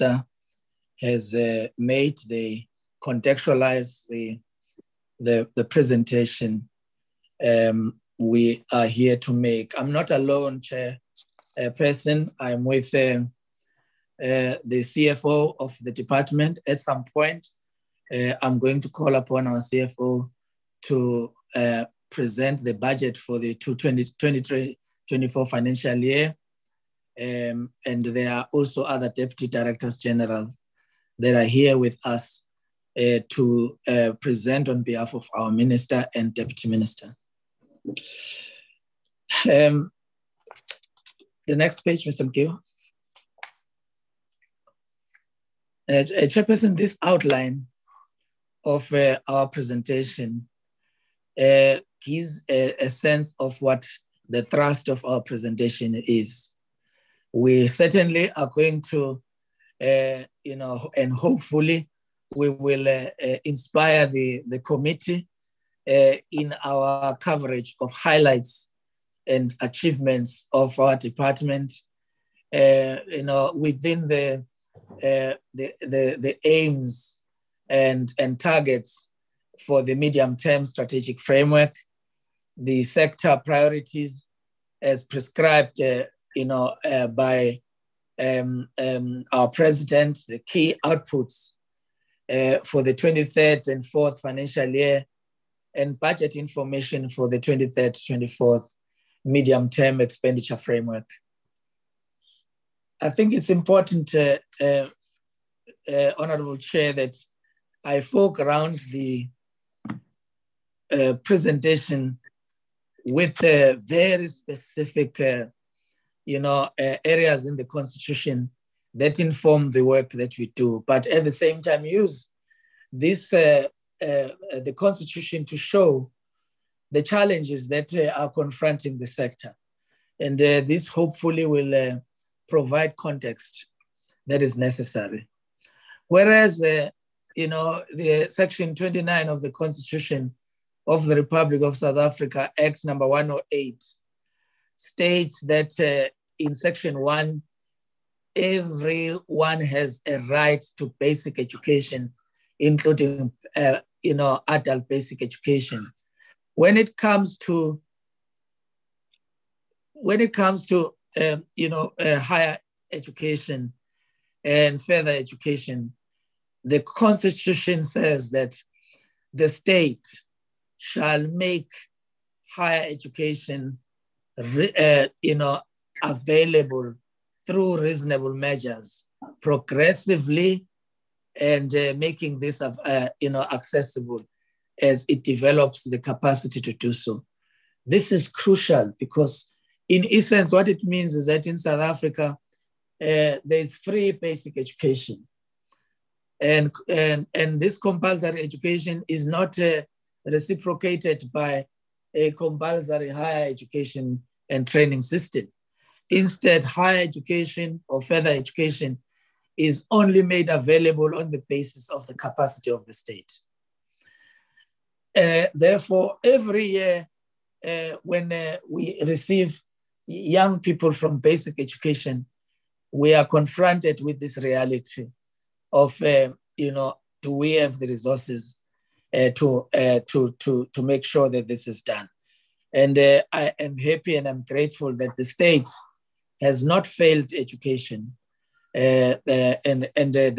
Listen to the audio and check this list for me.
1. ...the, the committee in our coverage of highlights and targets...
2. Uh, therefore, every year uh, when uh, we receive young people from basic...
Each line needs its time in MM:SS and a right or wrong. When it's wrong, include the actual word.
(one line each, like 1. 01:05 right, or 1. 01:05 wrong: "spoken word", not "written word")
1. 01:04 wrong: "achievements", not "targets"
2. 03:35 right.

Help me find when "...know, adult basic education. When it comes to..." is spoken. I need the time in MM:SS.
02:34.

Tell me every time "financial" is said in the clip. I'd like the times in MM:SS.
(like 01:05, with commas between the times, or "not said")
00:25, 01:34.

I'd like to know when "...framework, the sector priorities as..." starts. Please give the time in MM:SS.
01:21.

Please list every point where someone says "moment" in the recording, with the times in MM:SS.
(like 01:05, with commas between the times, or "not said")
not said.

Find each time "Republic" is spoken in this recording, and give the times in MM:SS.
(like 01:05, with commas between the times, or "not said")
02:21.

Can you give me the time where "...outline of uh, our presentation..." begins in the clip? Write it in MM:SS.
00:47.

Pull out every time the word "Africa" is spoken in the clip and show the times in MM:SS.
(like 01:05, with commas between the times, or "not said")
02:21, 03:11.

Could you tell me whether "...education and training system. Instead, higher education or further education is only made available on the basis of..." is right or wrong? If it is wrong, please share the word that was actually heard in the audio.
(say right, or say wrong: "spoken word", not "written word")
right.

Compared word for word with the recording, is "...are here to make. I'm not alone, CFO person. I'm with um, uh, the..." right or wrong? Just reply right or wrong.
wrong.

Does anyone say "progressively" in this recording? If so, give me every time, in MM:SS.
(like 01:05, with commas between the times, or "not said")
02:59.